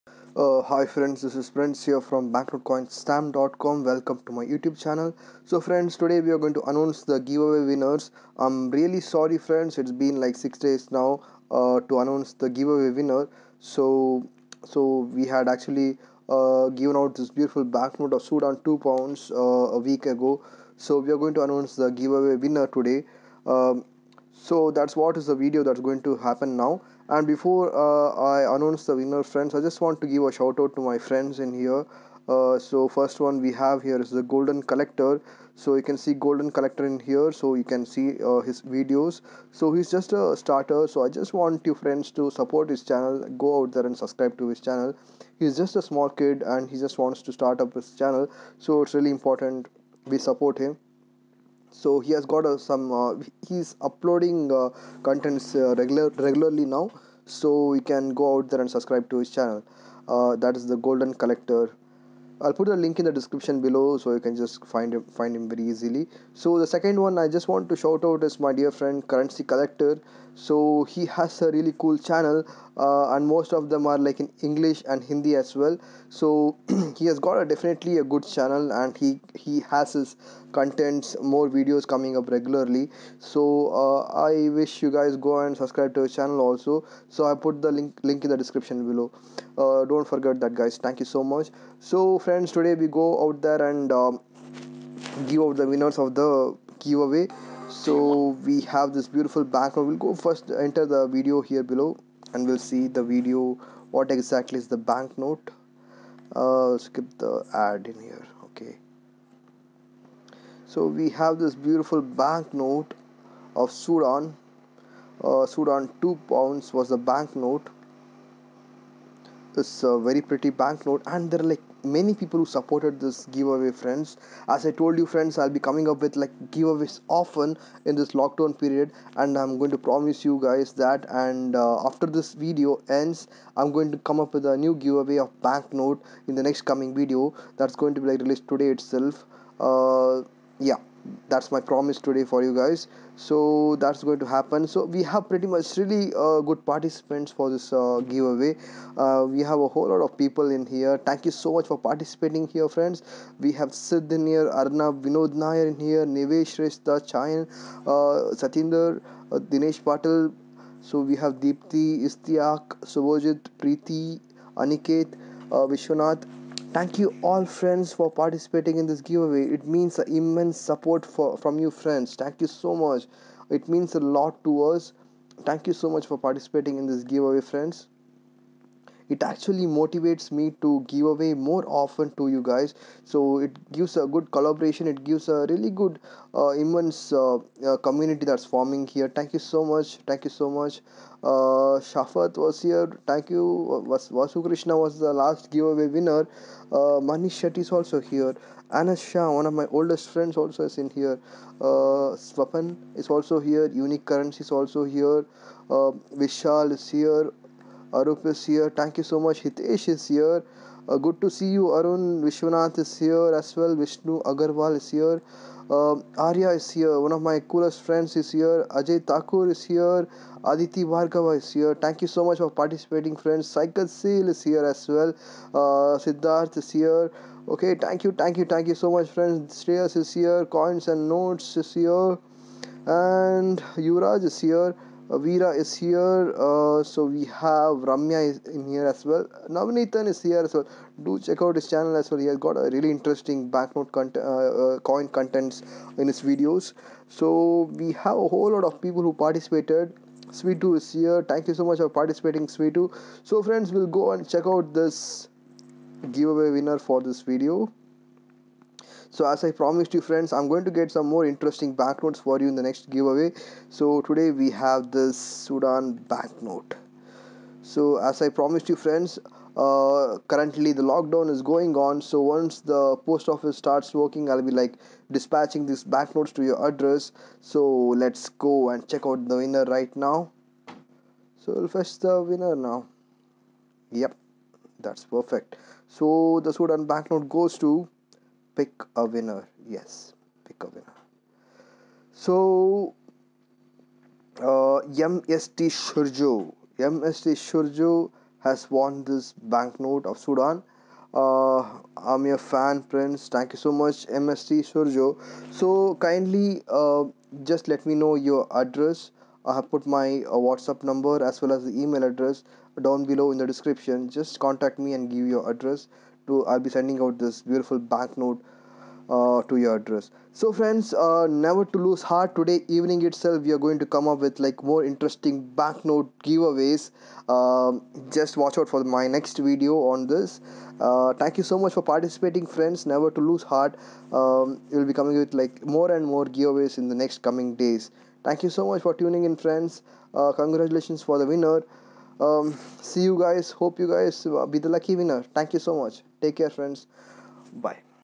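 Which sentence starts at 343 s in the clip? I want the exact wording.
Hope you guys uh, be the lucky winner.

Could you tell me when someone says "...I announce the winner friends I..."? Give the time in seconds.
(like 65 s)
28 s.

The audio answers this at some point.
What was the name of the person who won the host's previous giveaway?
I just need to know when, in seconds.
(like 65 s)
194 s.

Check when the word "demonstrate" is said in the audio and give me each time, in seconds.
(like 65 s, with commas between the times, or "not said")
not said.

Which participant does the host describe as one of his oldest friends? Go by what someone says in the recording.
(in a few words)
Anas Shah.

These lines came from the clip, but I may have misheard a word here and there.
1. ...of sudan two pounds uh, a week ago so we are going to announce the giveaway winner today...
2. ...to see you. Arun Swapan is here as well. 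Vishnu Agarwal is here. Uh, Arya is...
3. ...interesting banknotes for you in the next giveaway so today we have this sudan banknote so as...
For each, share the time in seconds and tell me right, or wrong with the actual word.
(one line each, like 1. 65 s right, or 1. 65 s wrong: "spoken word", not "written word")
1. 18 s right
2. 211 s wrong: "Vishwanath", not "Swapan"
3. 261 s right.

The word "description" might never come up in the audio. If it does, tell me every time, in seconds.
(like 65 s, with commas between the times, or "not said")
63 s, 88 s, 313 s.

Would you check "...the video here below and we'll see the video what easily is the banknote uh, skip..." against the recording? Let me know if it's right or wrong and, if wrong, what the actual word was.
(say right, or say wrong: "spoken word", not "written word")
wrong: "exactly", not "easily".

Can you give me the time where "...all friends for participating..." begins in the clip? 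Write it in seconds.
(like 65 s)
167 s.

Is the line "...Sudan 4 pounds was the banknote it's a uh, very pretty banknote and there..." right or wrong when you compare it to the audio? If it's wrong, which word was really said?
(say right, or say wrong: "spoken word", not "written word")
wrong: "2", not "4".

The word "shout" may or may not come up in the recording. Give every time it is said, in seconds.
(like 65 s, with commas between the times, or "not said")
30 s, 67 s.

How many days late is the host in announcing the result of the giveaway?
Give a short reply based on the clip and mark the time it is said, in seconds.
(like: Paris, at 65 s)
6, at 10 s.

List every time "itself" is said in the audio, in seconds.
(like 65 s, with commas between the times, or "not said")
138 s, 323 s.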